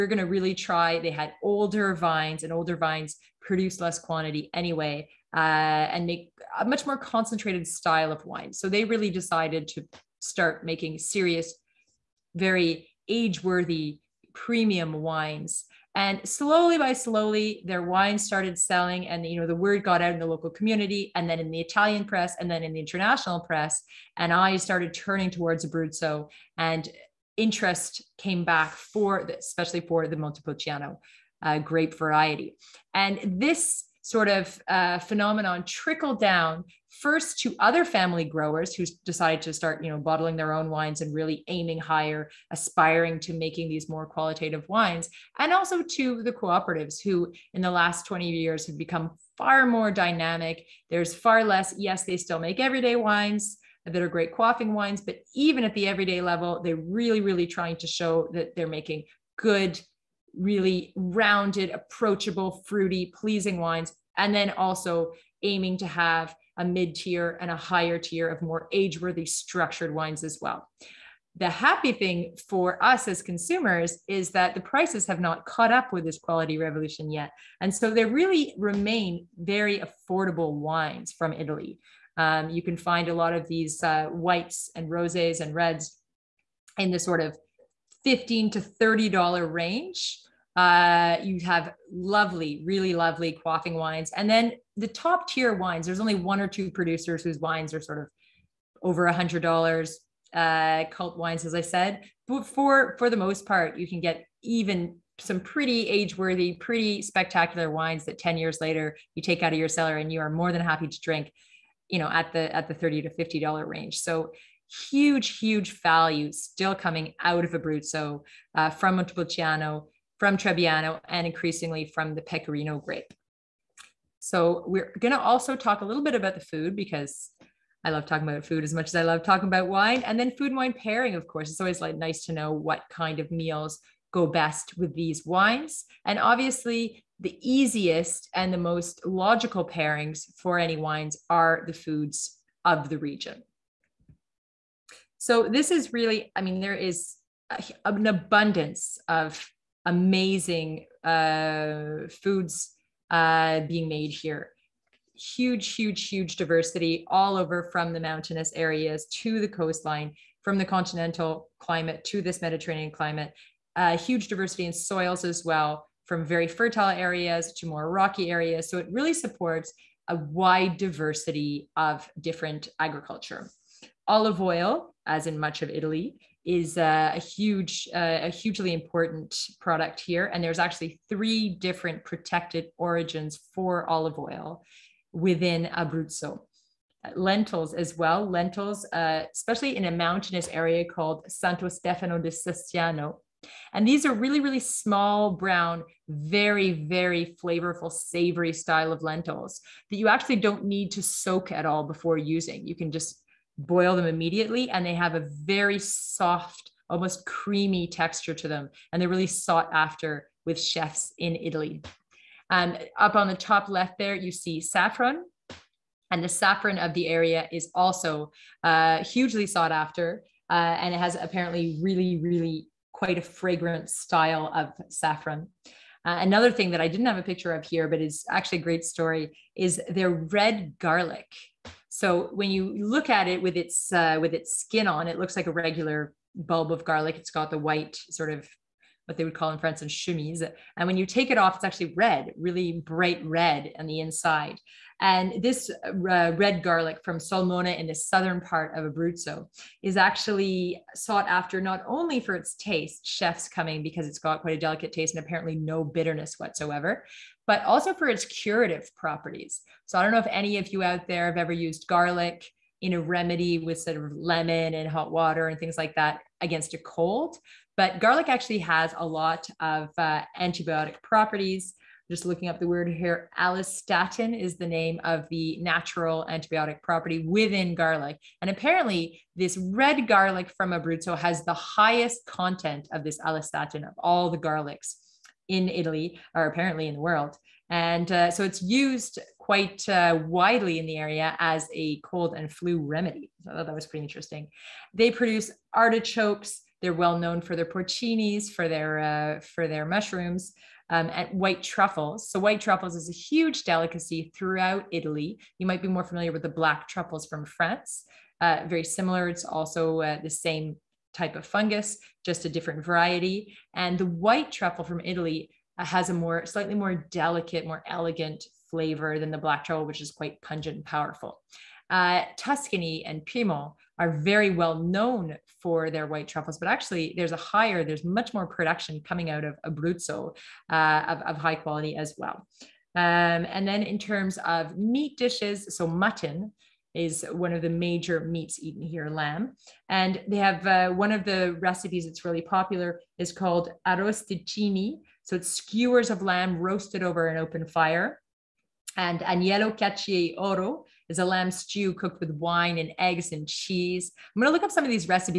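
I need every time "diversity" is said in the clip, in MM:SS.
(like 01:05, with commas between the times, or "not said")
02:36, 02:44, 02:50.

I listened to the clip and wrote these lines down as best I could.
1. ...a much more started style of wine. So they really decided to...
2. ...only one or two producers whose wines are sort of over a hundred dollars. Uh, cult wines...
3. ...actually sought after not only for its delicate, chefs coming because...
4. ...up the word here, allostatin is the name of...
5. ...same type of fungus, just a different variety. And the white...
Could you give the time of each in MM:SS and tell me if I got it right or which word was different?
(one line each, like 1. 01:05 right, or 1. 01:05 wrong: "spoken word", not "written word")
1. 00:06 wrong: "concentrated", not "started"
2. 01:35 right
3. 04:09 wrong: "taste", not "delicate"
4. 04:32 right
5. 05:10 right.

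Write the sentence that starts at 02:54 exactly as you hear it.
Olive oil, as in much of Italy, is a huge, uh, a hugely important product here.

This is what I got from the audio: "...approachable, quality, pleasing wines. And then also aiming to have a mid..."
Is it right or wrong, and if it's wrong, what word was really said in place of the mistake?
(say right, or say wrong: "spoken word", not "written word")
wrong: "fruity", not "quality".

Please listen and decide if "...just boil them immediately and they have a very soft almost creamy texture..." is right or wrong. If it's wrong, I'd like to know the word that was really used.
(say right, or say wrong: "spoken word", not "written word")
right.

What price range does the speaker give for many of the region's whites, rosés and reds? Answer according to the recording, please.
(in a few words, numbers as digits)
$15 to $30.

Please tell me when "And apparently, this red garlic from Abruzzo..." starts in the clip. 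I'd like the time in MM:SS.
04:38.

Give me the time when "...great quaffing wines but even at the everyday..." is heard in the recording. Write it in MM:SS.
00:54.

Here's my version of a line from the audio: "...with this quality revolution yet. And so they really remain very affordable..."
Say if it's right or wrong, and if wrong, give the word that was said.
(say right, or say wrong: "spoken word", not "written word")
right.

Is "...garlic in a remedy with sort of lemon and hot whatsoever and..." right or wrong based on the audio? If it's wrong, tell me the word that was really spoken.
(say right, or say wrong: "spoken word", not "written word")
wrong: "water", not "whatsoever".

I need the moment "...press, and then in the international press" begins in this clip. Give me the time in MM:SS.
00:22.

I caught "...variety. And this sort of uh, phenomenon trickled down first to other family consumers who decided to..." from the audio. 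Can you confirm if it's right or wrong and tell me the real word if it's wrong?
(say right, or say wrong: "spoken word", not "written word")
wrong: "growers", not "consumers".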